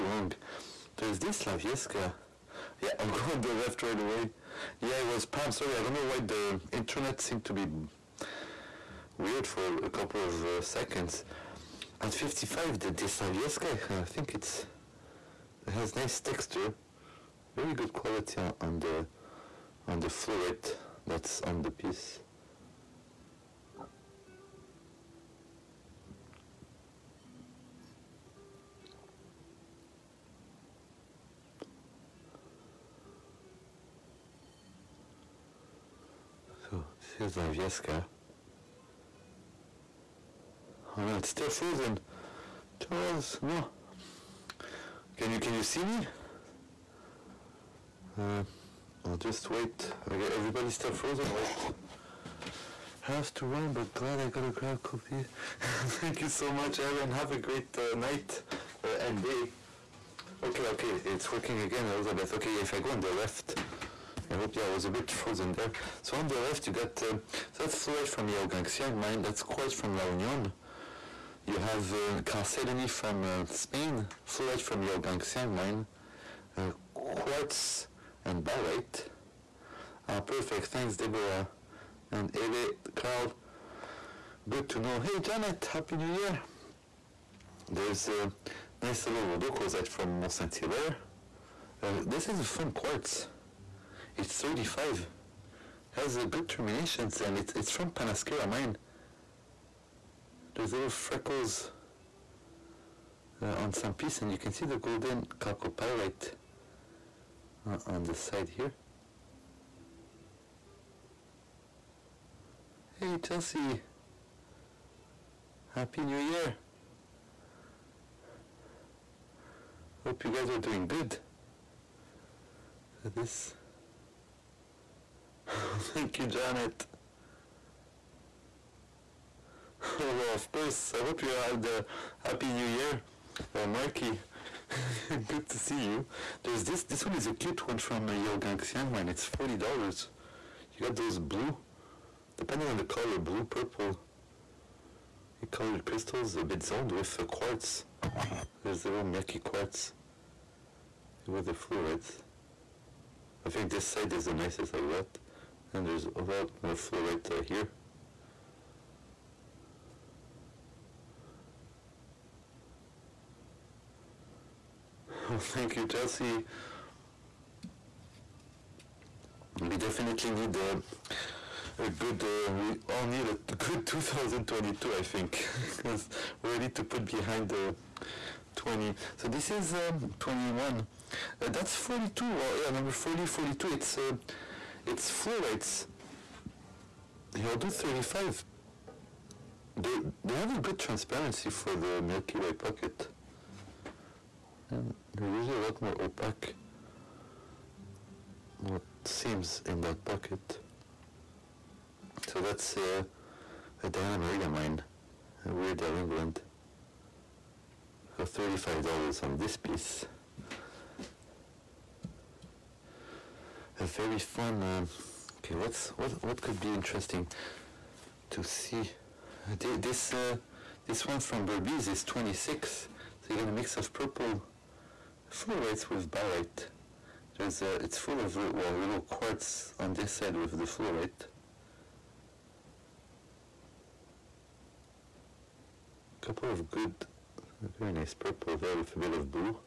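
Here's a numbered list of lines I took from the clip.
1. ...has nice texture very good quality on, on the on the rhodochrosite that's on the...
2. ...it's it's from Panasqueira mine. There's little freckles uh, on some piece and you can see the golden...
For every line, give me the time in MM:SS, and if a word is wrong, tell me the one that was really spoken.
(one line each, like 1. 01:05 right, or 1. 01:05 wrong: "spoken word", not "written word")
1. 00:15 wrong: "fluorite", not "rhodochrosite"
2. 01:37 right.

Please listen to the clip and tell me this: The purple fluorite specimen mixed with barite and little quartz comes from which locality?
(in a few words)
Berbes.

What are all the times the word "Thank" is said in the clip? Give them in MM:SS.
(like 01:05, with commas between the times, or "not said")
00:55, 01:20, 02:05, 02:45.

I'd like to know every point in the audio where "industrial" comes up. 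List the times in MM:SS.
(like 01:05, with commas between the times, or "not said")
not said.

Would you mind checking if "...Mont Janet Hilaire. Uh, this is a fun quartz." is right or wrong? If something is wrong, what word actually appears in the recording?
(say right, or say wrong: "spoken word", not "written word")
wrong: "Saint", not "Janet".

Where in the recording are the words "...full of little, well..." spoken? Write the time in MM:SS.
03:47.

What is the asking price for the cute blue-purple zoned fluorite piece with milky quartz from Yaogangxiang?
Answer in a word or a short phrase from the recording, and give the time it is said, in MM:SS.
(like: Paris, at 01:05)
$40, at 02:19.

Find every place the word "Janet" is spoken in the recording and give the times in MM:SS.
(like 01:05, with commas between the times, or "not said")
01:25, 02:06.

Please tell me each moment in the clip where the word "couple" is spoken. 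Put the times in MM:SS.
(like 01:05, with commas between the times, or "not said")
00:09, 03:56.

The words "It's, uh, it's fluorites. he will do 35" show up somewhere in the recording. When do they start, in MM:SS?
03:03.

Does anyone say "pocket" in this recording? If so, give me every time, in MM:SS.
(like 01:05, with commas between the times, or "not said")
03:12, 03:20.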